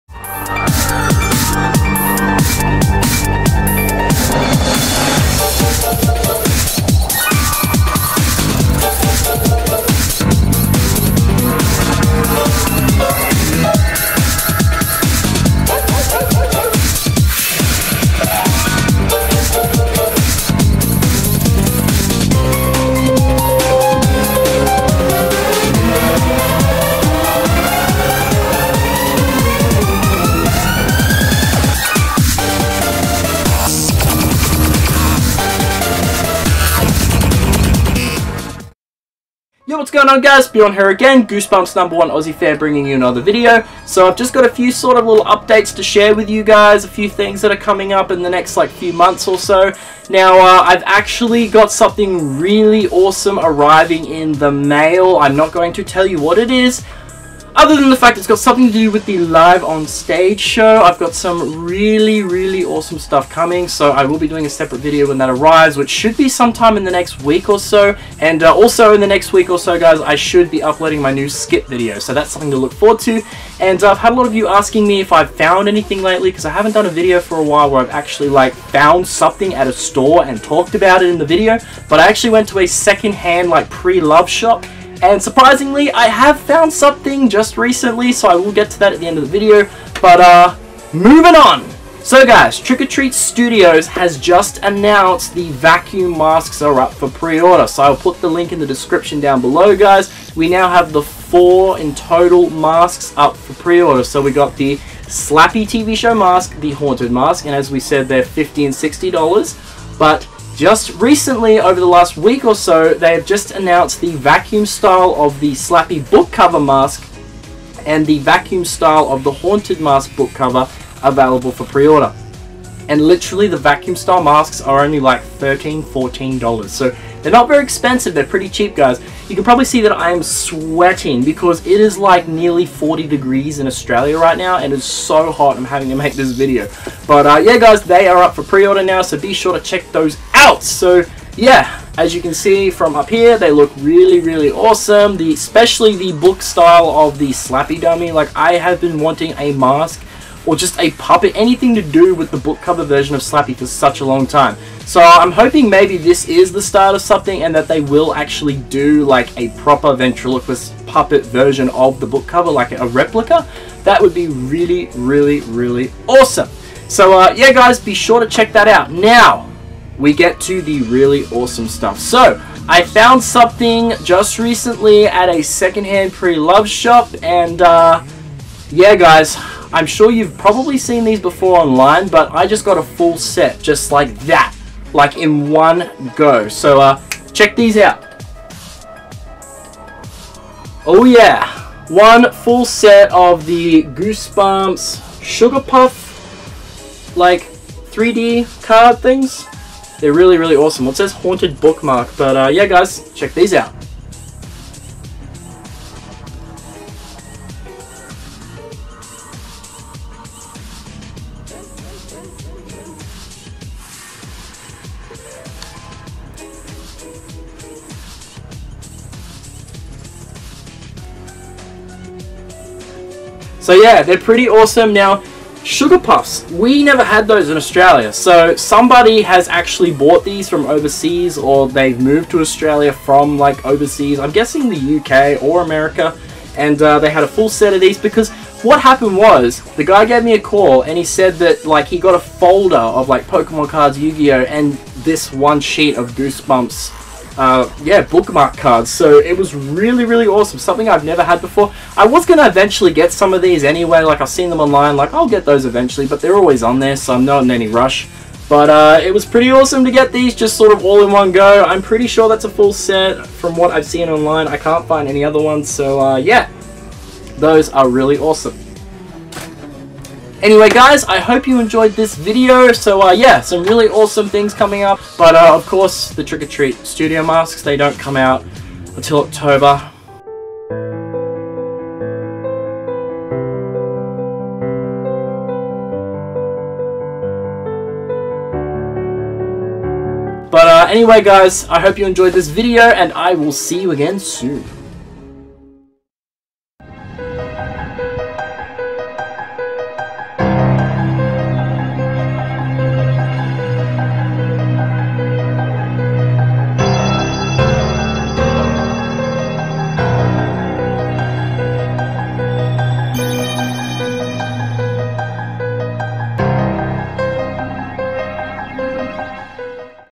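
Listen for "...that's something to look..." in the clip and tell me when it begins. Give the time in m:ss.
1:12.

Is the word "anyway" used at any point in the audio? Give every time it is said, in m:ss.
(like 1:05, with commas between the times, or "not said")
4:13, 4:30, 4:50.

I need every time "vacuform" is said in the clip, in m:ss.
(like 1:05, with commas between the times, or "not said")
1:35, 1:54, 1:58, 2:03.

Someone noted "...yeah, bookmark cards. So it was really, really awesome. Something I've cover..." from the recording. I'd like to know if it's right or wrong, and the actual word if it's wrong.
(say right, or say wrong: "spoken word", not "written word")
wrong: "never", not "cover".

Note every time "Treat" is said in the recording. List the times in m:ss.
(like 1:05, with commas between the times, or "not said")
1:32, 4:36.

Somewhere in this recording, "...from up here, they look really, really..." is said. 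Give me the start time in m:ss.
2:22.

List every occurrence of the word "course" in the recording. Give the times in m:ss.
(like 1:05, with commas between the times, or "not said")
4:35.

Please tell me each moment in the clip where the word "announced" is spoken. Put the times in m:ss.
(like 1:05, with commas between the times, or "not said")
1:34, 1:53.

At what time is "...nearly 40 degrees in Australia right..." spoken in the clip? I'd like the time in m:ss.
2:12.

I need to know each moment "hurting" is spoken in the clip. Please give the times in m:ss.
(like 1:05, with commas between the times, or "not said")
not said.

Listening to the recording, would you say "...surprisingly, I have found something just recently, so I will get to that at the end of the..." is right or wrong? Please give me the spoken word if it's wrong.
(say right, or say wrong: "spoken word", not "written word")
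right.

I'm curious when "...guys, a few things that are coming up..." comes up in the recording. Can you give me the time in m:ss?
0:46.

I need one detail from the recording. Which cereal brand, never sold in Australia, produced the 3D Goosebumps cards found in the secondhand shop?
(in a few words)
Sugar Puffs.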